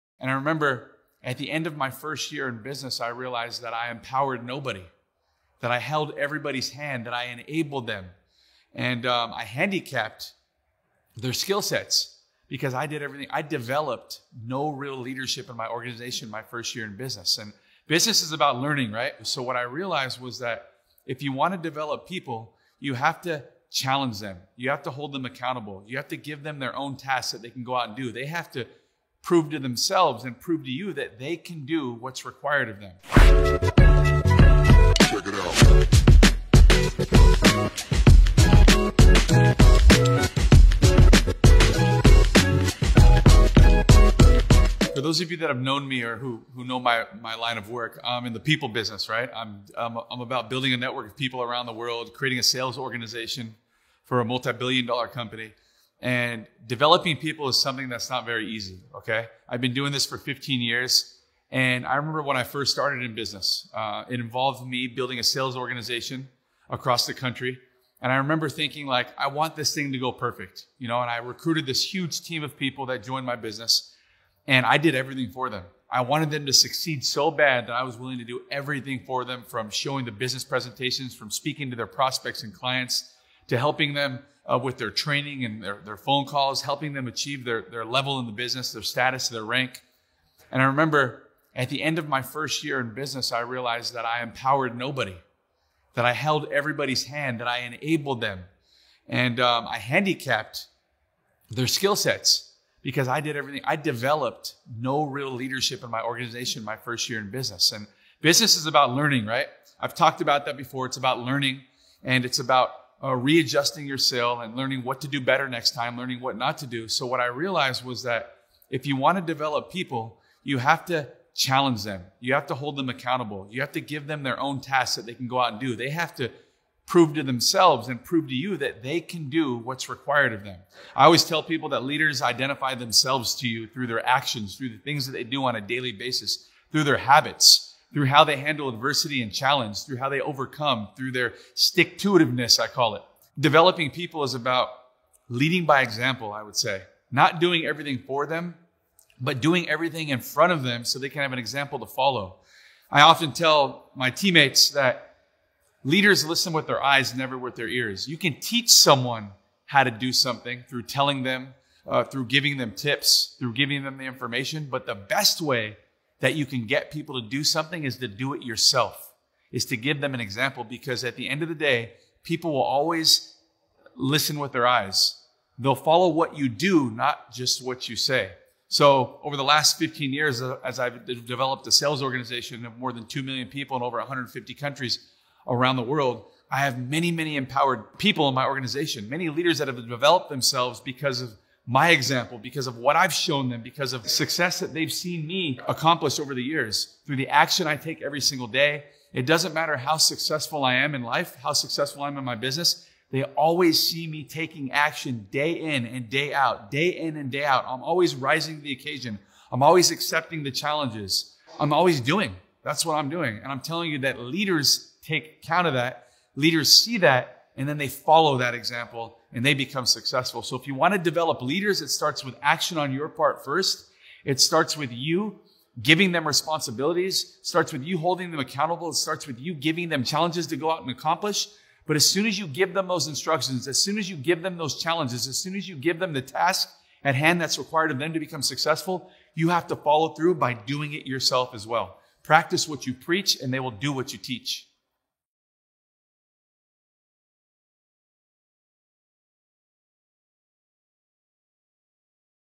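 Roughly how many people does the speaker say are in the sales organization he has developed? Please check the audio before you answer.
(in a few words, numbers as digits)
2 million.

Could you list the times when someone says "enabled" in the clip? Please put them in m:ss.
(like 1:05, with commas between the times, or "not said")
0:07, 1:37.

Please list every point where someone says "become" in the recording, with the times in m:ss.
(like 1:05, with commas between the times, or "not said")
3:39, 3:58.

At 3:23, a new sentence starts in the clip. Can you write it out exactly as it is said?
They always see me taking action day in and day out, day in and day out.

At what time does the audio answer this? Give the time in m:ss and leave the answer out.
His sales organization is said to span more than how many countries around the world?
3:03.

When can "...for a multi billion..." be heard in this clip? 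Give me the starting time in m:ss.
0:54.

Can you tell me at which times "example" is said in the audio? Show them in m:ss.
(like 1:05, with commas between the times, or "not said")
2:25, 2:31, 2:50, 3:11, 3:38.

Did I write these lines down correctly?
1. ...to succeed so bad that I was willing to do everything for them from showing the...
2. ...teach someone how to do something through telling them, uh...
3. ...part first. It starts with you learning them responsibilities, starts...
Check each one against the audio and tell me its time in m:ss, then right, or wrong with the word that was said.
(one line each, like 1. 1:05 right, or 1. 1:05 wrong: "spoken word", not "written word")
1. 1:16 right
2. 2:38 right
3. 3:43 wrong: "giving", not "learning".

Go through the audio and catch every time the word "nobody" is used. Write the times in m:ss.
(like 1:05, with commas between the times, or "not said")
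0:04, 1:34.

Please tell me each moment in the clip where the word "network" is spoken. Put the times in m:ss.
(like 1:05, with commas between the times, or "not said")
0:50.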